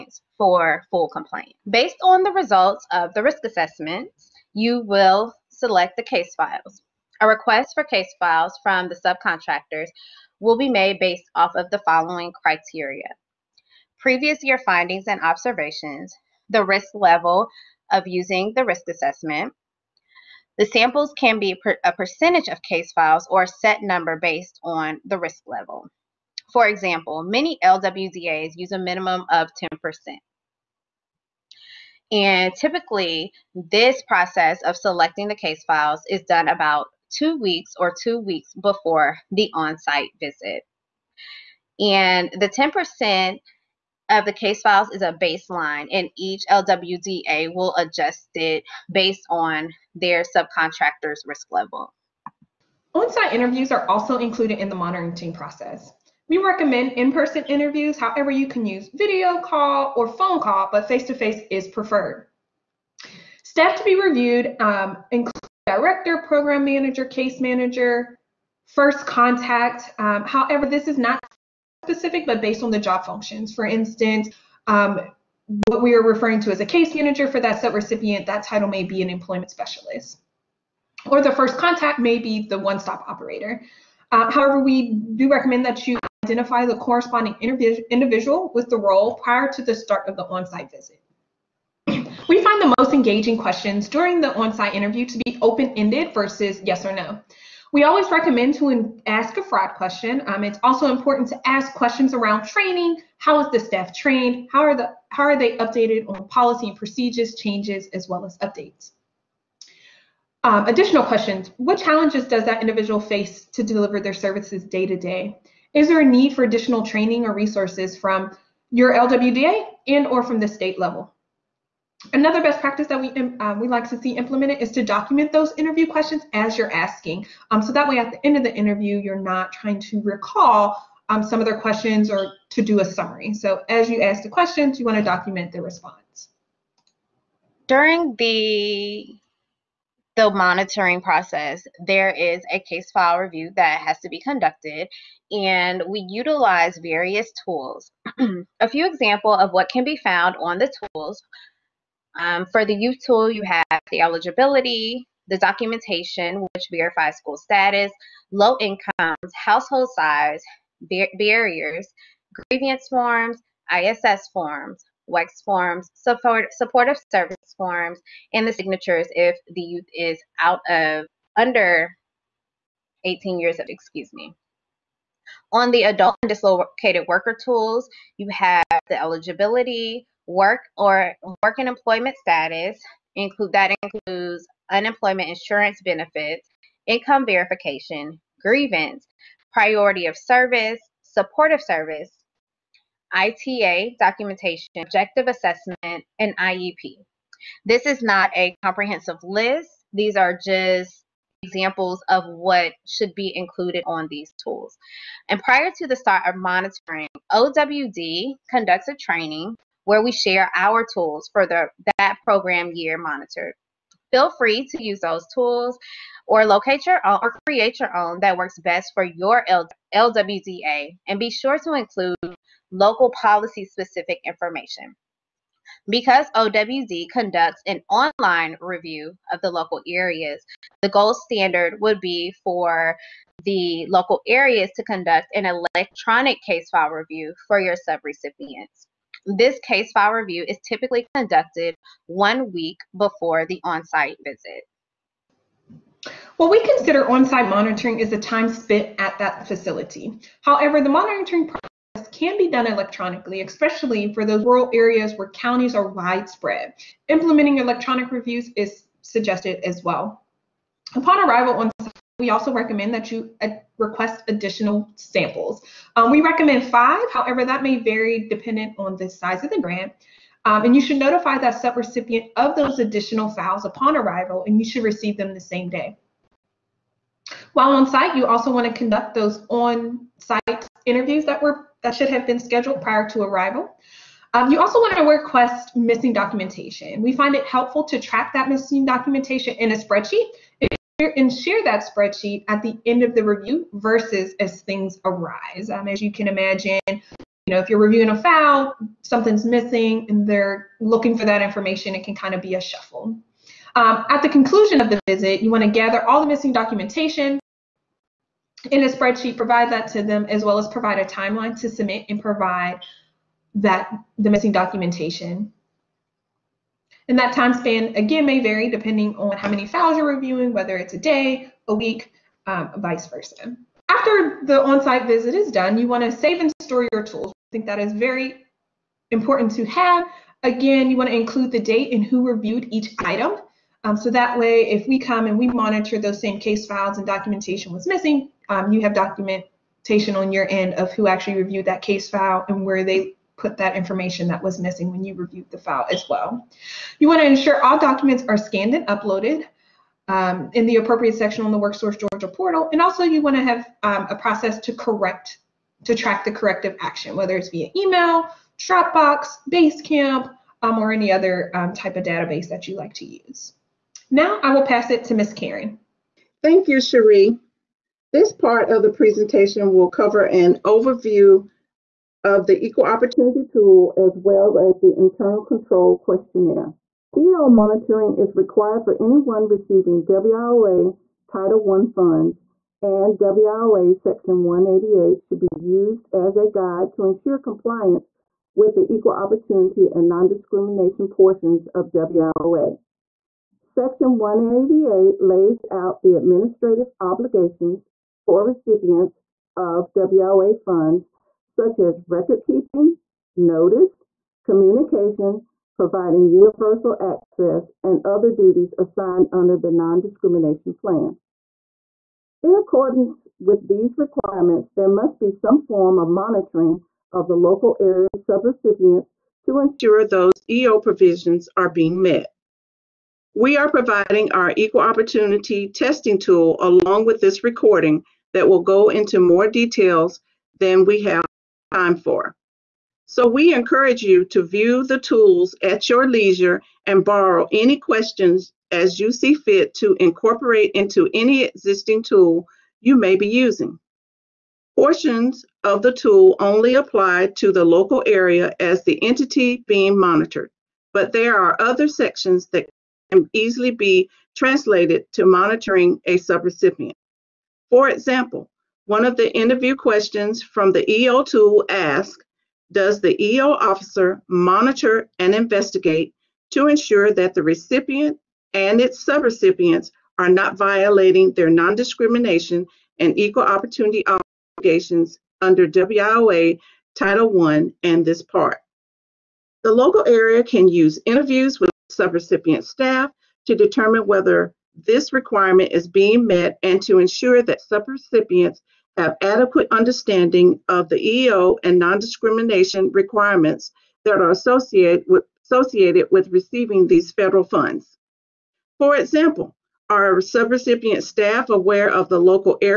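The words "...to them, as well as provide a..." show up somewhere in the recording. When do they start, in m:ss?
5:09.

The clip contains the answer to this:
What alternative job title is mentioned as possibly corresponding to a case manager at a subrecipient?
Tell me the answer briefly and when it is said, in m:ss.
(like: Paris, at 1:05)
employment specialist, at 1:19.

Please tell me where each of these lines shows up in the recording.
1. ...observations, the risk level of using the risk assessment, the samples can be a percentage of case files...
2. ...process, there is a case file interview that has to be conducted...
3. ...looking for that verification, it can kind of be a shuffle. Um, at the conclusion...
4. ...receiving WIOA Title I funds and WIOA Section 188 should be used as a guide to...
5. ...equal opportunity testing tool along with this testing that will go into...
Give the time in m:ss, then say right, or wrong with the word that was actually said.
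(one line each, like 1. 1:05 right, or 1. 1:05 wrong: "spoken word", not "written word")
1. 0:15 right
2. 2:21 wrong: "review", not "interview"
3. 5:00 wrong: "information", not "verification"
4. 6:19 right
5. 7:04 wrong: "recording", not "testing".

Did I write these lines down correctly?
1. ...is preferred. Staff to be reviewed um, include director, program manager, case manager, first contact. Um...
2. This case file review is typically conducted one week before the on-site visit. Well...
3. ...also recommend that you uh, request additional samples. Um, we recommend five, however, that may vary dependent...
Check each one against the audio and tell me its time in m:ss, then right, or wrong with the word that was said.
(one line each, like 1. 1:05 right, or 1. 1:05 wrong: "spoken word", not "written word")
1. 1:01 right
2. 3:59 right
3. 4:22 right.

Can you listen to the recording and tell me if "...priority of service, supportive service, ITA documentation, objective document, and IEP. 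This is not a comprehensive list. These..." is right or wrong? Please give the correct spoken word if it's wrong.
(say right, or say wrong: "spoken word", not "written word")
wrong: "assessment", not "document".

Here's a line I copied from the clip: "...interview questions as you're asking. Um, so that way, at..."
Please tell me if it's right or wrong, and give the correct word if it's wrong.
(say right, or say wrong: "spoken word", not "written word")
right.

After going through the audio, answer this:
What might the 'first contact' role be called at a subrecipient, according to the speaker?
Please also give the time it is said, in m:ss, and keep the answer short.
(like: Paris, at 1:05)
one-stop operator, at 1:22.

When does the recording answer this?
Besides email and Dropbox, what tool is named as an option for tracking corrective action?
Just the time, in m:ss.
5:59.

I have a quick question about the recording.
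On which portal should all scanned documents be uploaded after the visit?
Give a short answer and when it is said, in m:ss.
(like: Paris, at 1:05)
WorkSource Georgia portal, at 5:51.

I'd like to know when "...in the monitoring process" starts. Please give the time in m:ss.
0:54.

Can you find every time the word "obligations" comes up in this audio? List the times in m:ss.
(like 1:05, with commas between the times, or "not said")
6:37, 7:54.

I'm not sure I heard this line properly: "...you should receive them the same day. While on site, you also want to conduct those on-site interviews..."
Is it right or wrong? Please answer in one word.
right.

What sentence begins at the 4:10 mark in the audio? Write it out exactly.
However, the monitoring process can be done electronically, especially for those rural areas where counties are widespread.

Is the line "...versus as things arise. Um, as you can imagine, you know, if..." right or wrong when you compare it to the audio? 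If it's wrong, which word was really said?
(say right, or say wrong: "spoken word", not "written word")
right.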